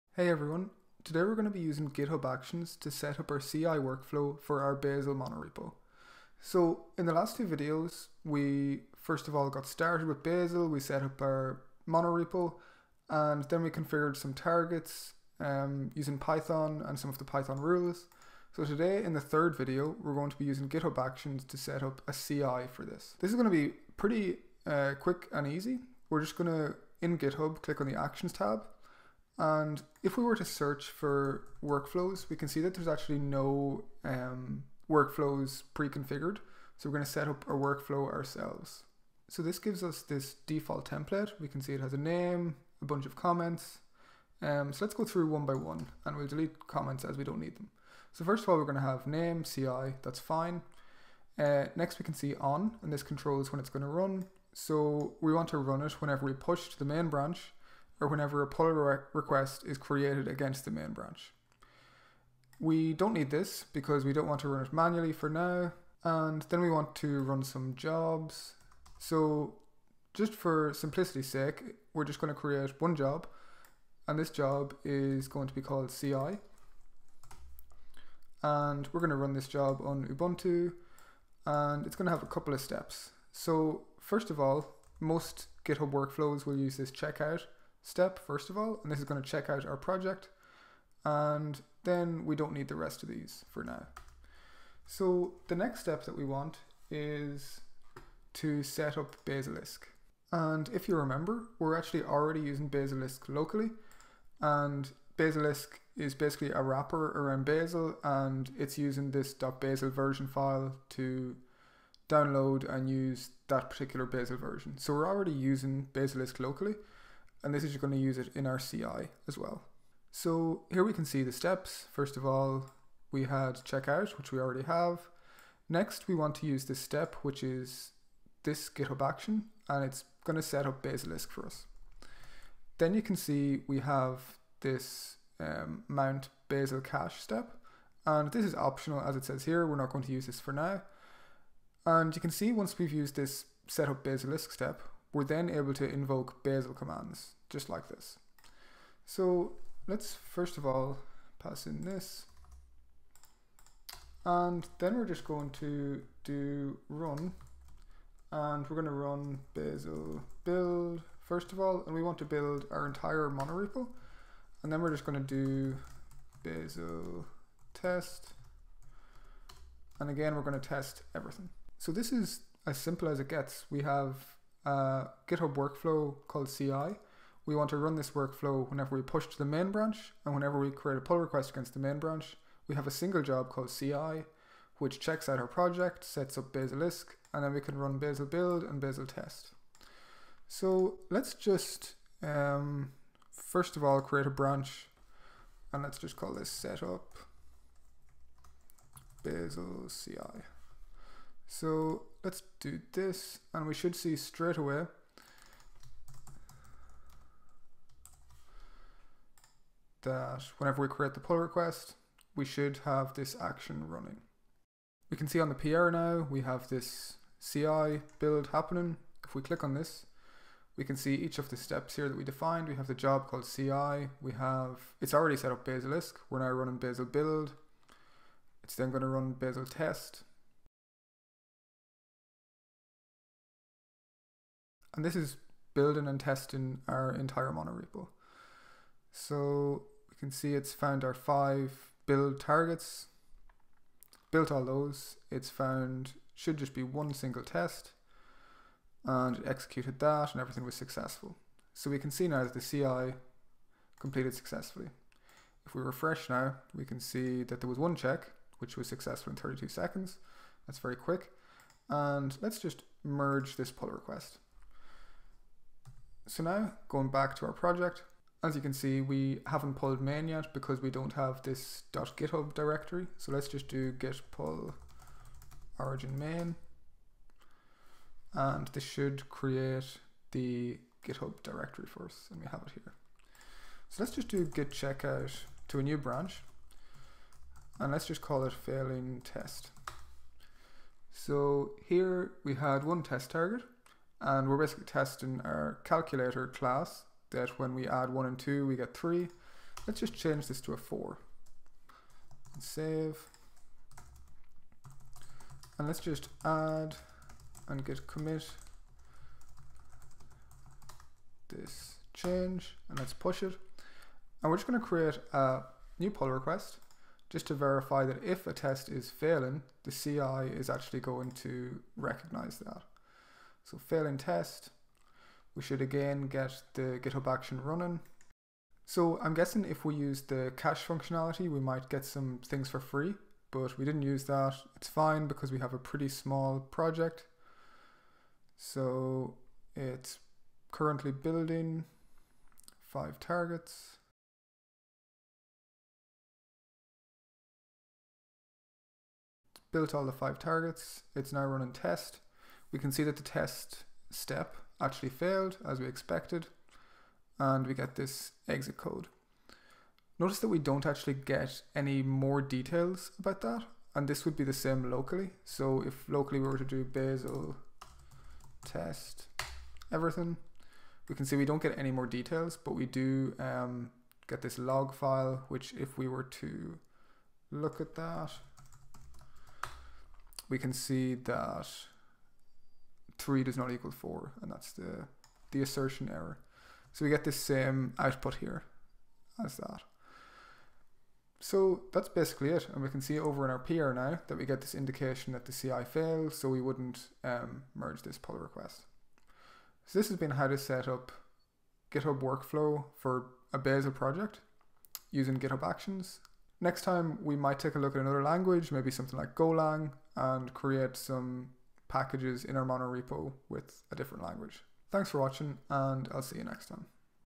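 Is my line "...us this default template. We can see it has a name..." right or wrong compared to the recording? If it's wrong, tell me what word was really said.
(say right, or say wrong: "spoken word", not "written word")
right.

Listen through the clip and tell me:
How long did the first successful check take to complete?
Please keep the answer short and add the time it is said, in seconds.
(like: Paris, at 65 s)
32 seconds, at 259 s.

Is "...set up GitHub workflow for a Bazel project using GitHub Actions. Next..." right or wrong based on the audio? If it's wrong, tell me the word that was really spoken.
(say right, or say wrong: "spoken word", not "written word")
right.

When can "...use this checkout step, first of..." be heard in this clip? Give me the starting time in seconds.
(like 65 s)
86 s.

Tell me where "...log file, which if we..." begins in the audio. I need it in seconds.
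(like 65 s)
374 s.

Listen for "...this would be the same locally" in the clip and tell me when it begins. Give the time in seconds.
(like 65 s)
364 s.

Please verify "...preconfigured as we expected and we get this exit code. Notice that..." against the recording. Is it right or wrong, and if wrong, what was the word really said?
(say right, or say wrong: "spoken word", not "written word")
wrong: "failed", not "preconfigured".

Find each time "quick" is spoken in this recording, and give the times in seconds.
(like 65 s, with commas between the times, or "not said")
24 s, 260 s.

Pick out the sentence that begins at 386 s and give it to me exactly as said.
So we get the same output here as that.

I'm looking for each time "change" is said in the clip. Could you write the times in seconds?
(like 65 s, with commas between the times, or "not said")
300 s, 312 s.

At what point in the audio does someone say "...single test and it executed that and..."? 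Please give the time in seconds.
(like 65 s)
247 s.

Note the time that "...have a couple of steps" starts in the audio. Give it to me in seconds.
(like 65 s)
82 s.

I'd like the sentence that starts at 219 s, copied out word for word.
If we click on this, we can see each of the steps here that we defined.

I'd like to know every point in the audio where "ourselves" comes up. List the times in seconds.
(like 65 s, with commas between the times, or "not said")
38 s.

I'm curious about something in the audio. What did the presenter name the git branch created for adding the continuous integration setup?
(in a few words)
setup Bazel CI.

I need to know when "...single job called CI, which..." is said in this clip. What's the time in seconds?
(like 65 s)
182 s.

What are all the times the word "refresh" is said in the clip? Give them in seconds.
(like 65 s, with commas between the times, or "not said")
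255 s.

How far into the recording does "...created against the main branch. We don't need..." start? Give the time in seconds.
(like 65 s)
59 s.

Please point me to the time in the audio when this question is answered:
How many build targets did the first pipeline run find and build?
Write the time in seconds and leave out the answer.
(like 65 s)
241 s.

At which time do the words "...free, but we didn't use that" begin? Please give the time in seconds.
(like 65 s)
332 s.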